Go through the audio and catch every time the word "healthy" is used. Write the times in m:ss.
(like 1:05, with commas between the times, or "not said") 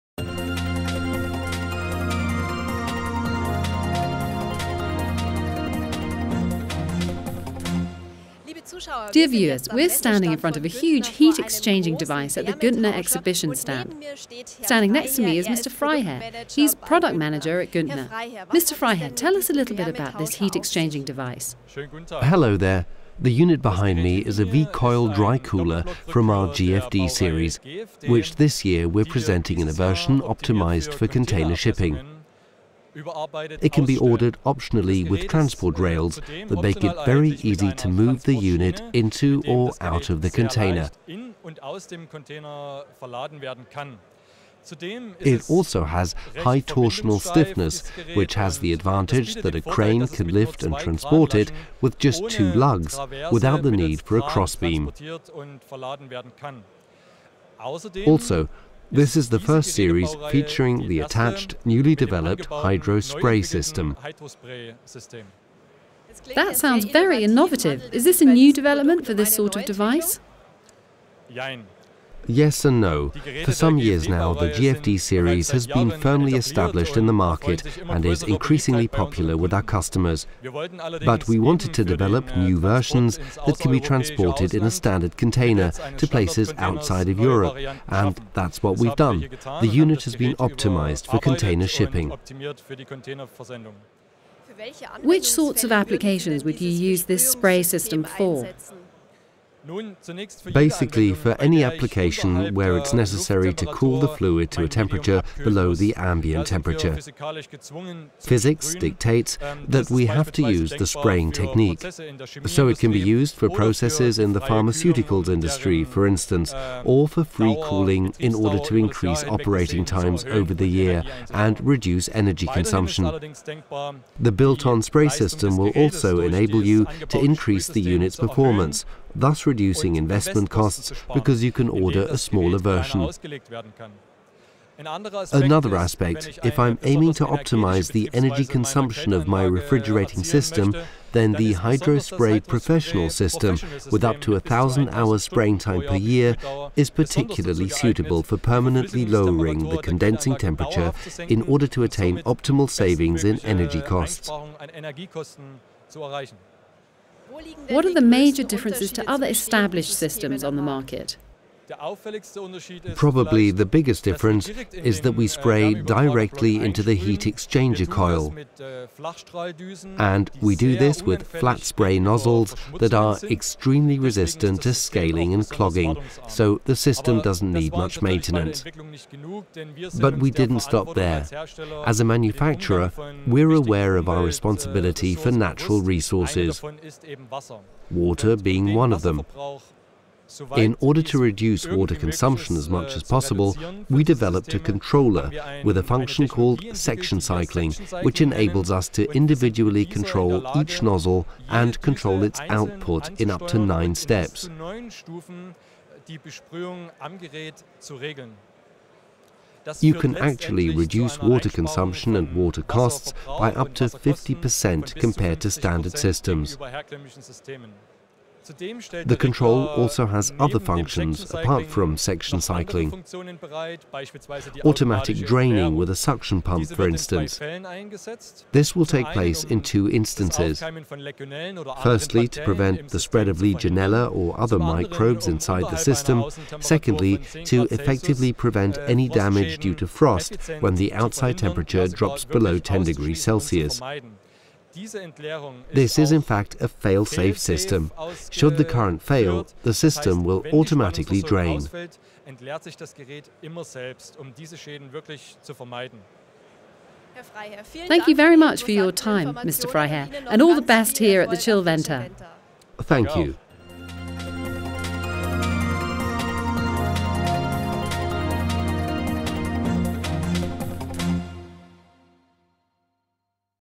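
not said.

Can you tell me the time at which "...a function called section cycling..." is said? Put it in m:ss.
3:15.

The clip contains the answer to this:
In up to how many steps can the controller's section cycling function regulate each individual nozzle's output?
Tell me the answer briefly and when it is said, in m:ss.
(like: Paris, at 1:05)
9, at 3:23.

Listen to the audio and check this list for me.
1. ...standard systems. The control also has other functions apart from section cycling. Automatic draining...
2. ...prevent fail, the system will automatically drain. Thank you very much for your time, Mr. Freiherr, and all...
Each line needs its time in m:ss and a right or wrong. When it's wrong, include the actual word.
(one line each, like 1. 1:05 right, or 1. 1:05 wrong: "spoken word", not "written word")
1. 3:35 right
2. 4:08 wrong: "current", not "prevent".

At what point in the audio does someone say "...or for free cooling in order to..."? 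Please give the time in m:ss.
1:56.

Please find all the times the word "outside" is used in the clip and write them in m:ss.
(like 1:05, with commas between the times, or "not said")
1:26, 4:00.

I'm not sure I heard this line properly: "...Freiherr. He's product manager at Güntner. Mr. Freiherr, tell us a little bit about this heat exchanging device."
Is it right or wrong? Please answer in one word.
right.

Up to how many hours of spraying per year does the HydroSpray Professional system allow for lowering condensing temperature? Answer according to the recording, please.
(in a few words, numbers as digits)
1,000.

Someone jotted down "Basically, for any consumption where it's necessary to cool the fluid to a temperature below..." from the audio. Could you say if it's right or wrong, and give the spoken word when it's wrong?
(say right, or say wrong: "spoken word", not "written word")
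wrong: "application", not "consumption".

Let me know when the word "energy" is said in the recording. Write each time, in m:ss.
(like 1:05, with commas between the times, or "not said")
2:02, 2:18, 2:33.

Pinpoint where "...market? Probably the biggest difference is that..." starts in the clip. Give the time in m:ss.
2:40.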